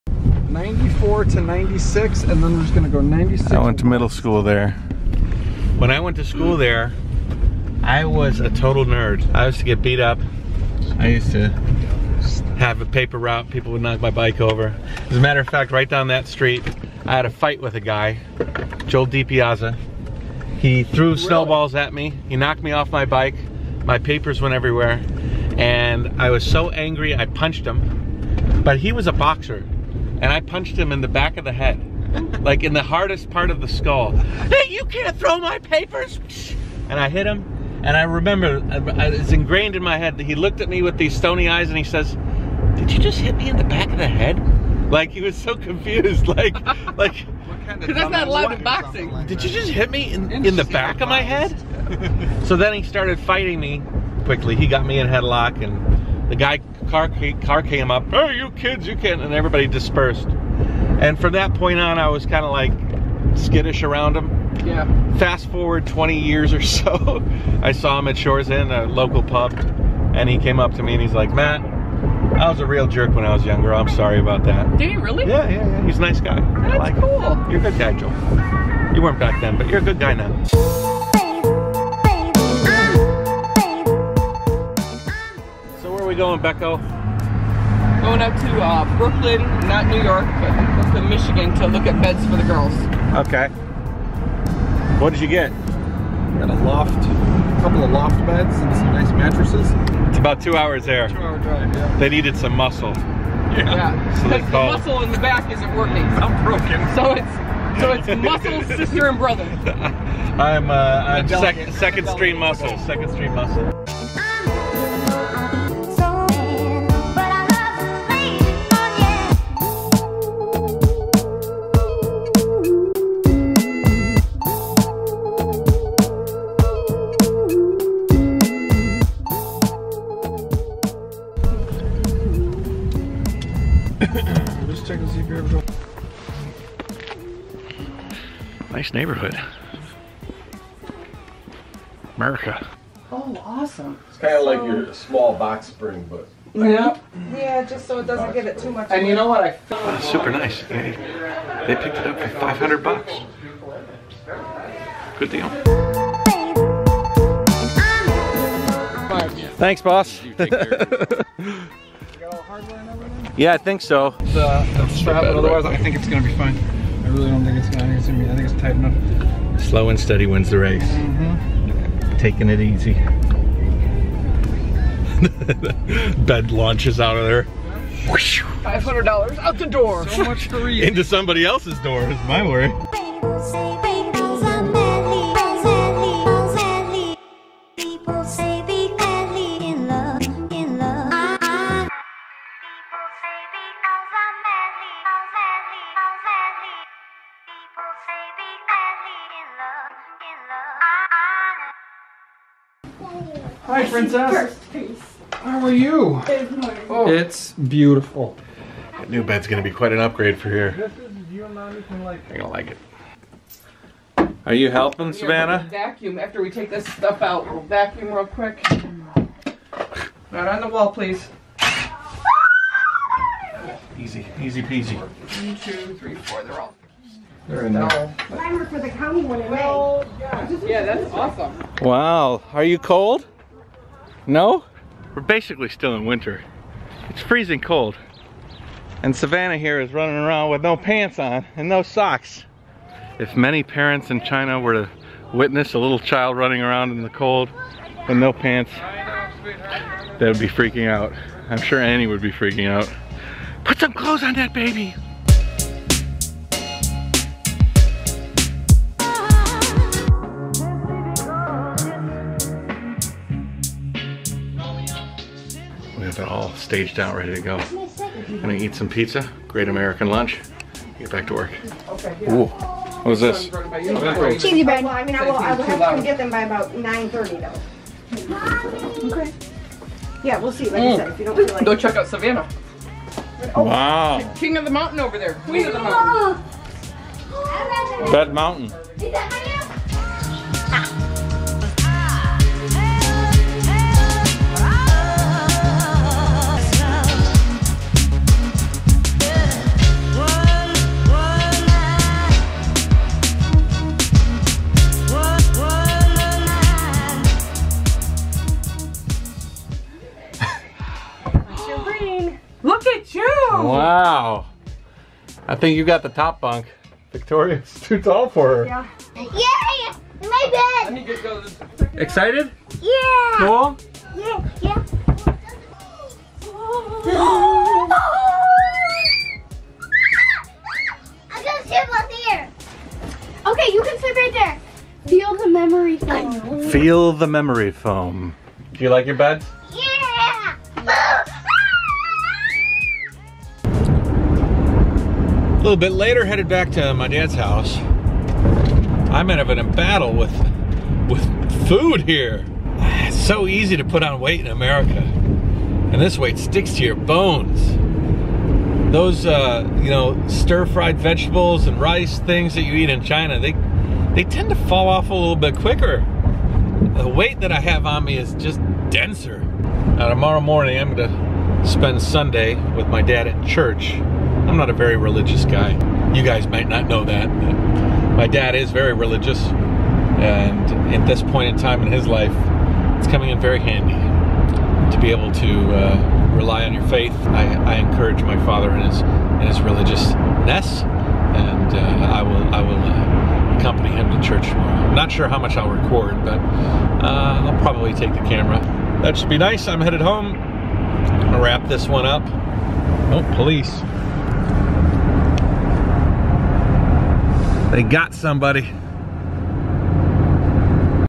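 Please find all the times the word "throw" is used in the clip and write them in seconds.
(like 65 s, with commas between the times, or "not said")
35 s.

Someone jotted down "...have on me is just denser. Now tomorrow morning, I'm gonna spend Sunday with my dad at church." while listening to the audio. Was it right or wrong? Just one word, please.
right.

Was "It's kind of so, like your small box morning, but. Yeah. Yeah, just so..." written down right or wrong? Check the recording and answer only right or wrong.
wrong.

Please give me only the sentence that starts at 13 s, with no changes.
People would knock my bike over.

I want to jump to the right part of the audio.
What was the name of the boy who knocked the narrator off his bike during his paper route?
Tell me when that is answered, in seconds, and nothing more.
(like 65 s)
18 s.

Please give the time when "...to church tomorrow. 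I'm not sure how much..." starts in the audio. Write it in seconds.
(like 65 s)
394 s.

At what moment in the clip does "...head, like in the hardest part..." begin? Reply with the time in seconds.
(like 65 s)
31 s.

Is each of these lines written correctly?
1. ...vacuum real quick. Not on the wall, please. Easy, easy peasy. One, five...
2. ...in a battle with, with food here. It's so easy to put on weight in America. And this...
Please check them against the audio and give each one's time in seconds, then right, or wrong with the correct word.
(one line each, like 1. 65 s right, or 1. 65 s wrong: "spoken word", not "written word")
1. 217 s wrong: "two", not "five"
2. 349 s right.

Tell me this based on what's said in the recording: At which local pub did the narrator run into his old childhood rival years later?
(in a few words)
Shores Inn.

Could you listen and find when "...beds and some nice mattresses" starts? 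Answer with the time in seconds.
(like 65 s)
98 s.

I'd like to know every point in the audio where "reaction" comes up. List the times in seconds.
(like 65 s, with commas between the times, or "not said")
not said.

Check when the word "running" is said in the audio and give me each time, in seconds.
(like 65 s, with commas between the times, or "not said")
239 s, 246 s.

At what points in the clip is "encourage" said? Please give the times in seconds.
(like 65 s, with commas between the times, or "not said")
387 s.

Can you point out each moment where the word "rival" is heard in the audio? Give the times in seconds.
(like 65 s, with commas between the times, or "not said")
not said.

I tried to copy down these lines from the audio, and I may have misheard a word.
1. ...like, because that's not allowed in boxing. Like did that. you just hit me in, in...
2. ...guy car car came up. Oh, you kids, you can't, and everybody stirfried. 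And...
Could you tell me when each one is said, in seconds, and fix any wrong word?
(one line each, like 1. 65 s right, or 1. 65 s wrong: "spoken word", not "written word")
1. 46 s right
2. 56 s wrong: "dispersed", not "stirfried".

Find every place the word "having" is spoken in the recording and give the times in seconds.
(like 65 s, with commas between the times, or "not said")
not said.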